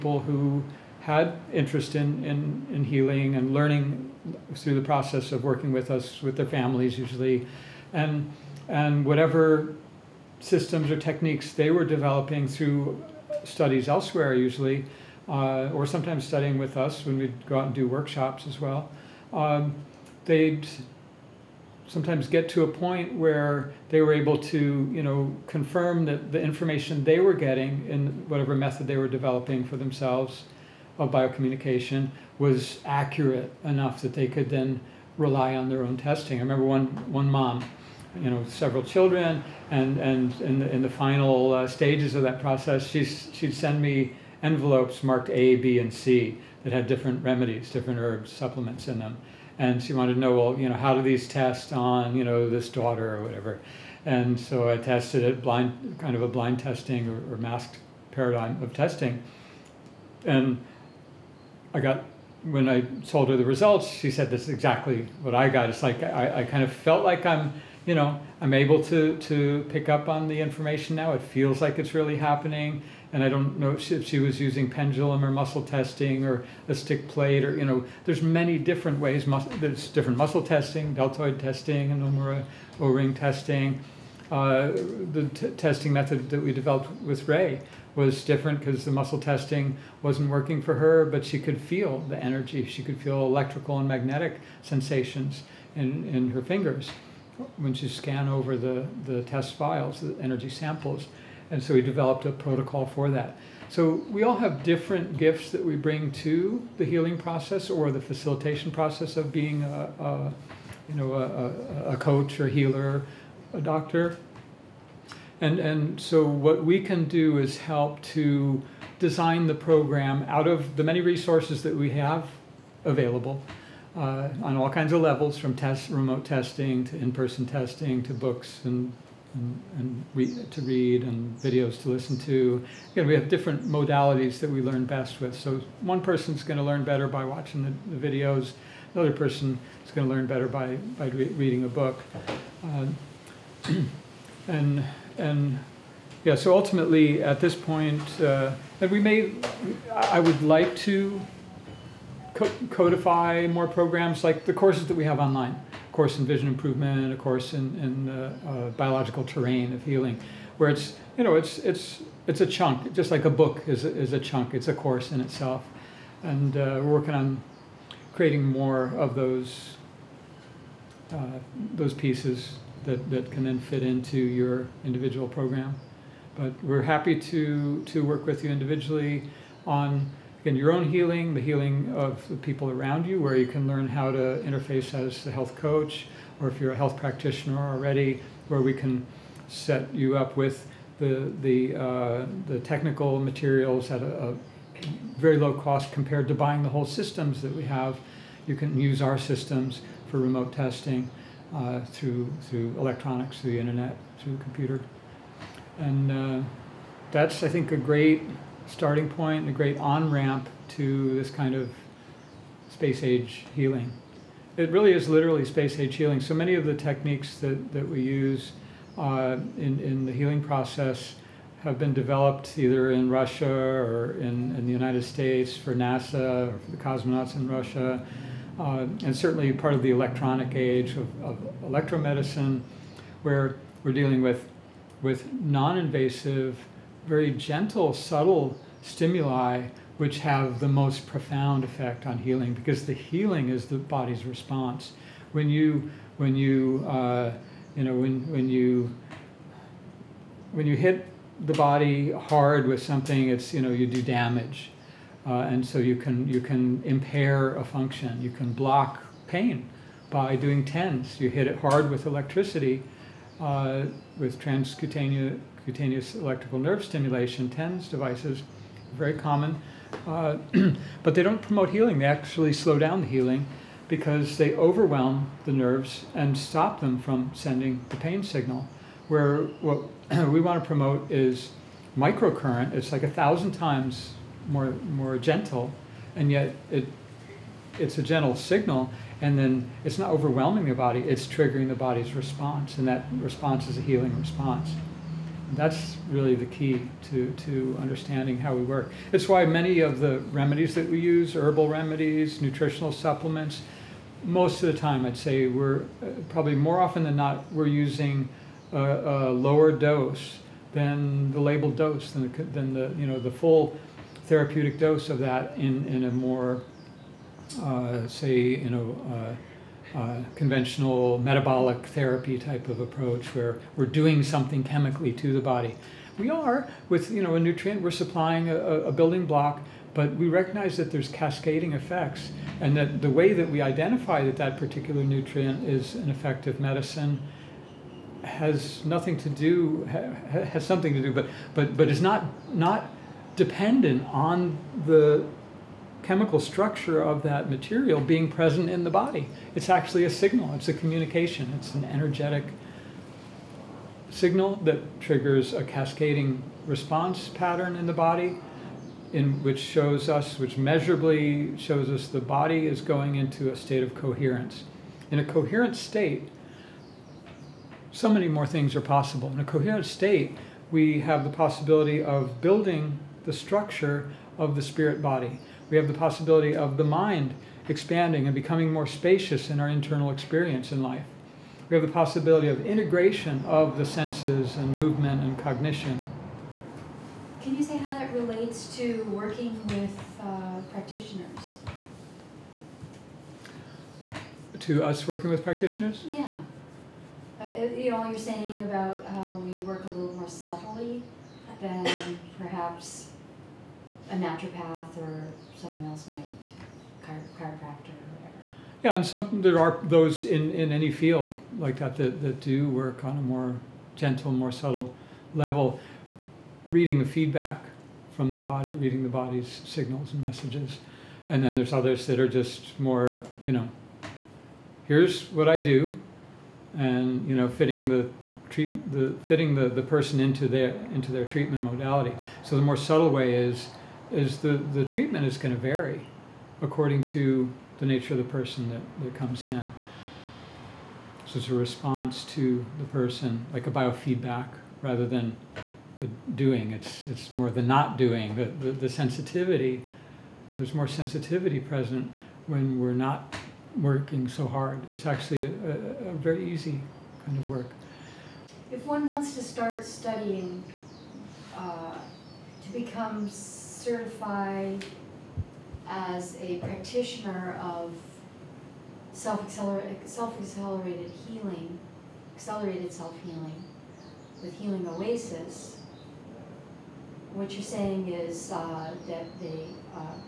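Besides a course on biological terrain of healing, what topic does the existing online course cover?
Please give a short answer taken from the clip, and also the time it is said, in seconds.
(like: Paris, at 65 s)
vision improvement, at 156 s.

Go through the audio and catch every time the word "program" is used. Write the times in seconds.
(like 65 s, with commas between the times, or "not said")
119 s, 153 s, 175 s.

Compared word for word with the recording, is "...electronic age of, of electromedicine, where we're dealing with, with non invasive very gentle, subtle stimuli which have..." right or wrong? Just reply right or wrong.
right.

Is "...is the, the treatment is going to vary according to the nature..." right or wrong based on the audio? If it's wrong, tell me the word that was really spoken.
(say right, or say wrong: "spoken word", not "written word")
right.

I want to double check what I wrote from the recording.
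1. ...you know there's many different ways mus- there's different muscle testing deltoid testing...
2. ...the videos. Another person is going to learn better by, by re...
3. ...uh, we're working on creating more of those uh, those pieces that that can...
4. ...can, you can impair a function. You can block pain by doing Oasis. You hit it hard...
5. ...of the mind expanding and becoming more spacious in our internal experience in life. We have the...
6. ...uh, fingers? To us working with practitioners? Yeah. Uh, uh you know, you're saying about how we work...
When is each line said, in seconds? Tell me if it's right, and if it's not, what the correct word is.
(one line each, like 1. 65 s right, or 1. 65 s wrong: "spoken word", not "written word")
1. 77 s right
2. 137 s right
3. 166 s right
4. 255 s wrong: "TENS", not "Oasis"
5. 376 s right
6. 390 s wrong: "practitioners", not "fingers".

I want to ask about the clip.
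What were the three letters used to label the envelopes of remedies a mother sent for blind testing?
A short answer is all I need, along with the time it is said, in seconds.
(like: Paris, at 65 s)
A, B, and C, at 45 s.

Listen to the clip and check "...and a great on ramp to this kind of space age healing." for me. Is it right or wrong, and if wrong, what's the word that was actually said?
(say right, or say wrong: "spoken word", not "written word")
right.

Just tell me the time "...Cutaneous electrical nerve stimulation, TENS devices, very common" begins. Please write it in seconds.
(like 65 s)
265 s.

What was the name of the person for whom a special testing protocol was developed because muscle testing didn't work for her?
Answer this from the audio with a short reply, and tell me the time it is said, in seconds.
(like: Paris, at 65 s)
Ray, at 87 s.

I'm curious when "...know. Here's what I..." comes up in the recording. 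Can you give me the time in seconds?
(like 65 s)
423 s.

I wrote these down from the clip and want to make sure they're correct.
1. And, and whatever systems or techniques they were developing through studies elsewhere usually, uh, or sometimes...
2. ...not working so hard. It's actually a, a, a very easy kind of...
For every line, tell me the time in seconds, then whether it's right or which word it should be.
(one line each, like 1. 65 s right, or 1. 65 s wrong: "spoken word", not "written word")
1. 7 s right
2. 452 s right.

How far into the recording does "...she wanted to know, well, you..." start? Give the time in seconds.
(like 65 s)
49 s.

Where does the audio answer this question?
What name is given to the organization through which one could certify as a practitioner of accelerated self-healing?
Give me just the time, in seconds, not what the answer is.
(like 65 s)
474 s.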